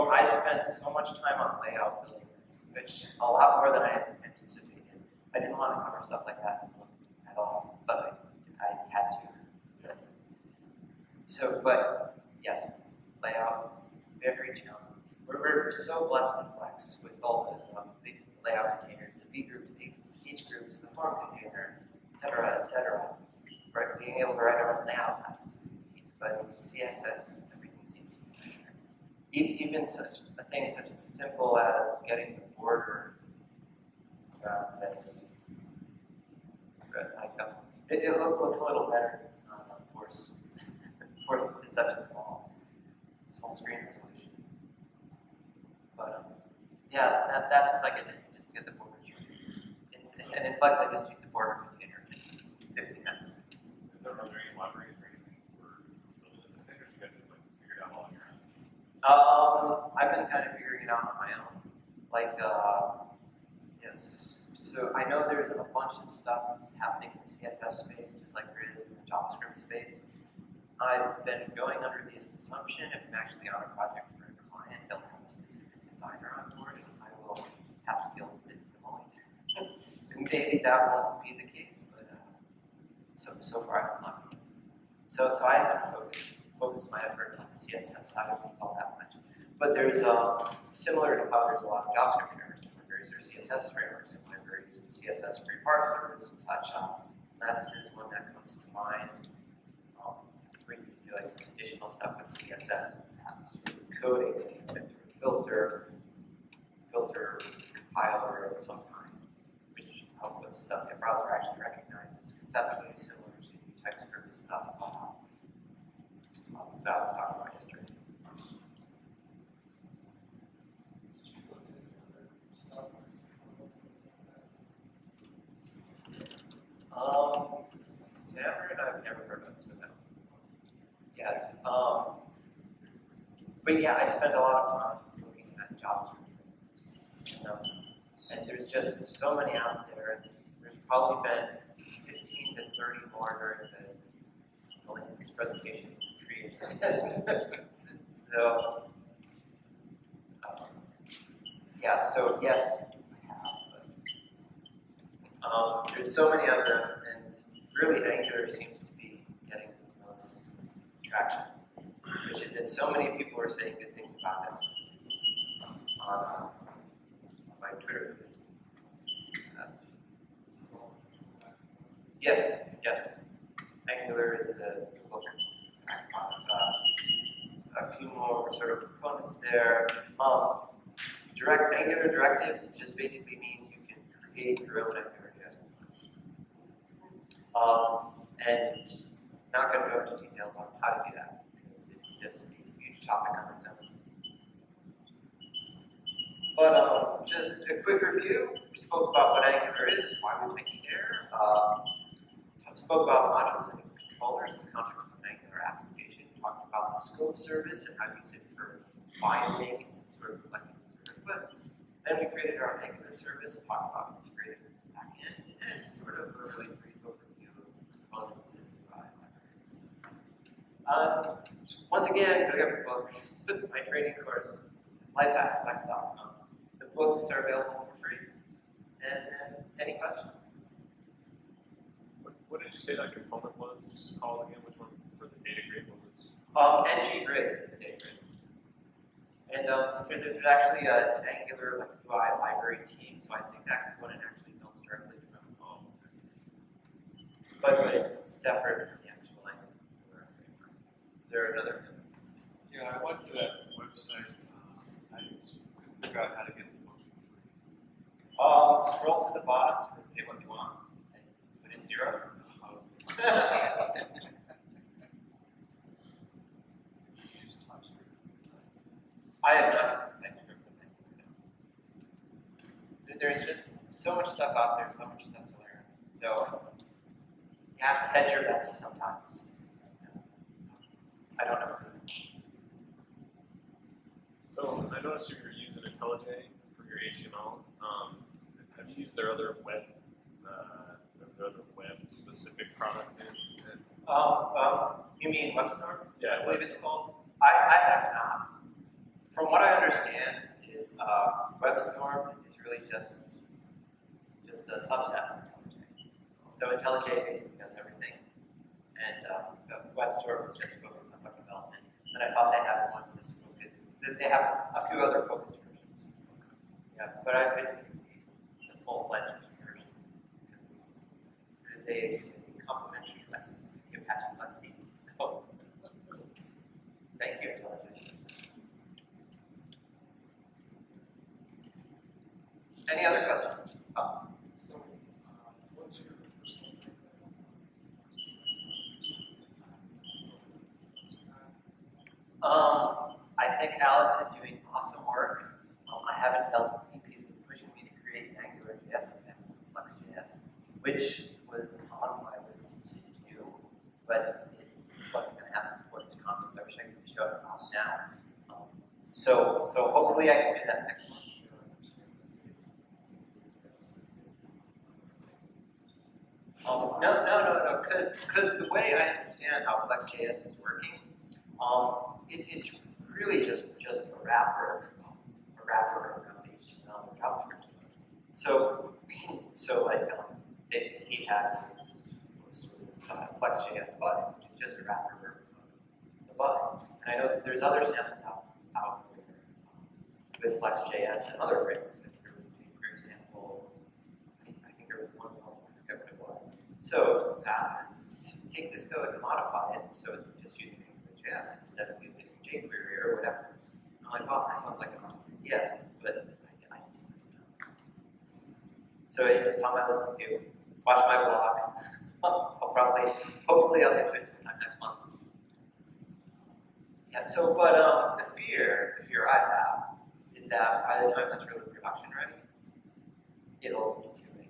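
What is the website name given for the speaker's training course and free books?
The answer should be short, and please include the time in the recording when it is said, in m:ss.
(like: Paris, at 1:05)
lifeafterflex.com, at 3:45.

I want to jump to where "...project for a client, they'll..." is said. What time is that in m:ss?
1:13.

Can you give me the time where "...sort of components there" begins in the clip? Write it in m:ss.
2:58.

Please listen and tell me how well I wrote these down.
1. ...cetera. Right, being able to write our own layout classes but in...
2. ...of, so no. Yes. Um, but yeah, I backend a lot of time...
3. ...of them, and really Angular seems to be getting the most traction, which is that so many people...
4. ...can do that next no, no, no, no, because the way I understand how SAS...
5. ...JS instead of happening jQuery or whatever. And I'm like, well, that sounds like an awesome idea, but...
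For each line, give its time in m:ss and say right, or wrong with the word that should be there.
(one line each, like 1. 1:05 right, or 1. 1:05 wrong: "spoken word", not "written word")
1. 0:22 right
2. 2:09 wrong: "spend", not "backend"
3. 2:36 right
4. 6:00 wrong: "FlexJS", not "SAS"
5. 6:41 wrong: "using", not "happening".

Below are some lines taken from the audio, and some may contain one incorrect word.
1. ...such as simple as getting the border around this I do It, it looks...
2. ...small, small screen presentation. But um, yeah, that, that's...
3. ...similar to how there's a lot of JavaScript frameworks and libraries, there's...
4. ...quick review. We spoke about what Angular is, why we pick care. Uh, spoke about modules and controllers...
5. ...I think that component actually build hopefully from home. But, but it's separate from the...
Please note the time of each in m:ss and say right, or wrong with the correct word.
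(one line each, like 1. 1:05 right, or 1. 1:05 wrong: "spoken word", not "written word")
1. 0:30 right
2. 0:42 wrong: "resolution", not "presentation"
3. 1:30 right
4. 3:17 right
5. 4:03 wrong: "directly", not "hopefully".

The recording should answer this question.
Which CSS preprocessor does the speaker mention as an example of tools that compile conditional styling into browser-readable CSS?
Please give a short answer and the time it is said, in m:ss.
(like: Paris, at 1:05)
Less, at 1:37.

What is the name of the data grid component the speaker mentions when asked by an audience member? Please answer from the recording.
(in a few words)
ng grid.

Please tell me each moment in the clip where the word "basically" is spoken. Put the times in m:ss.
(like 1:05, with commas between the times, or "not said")
3:02, 5:07.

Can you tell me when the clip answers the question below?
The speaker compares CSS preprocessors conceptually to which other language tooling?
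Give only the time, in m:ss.
1:53.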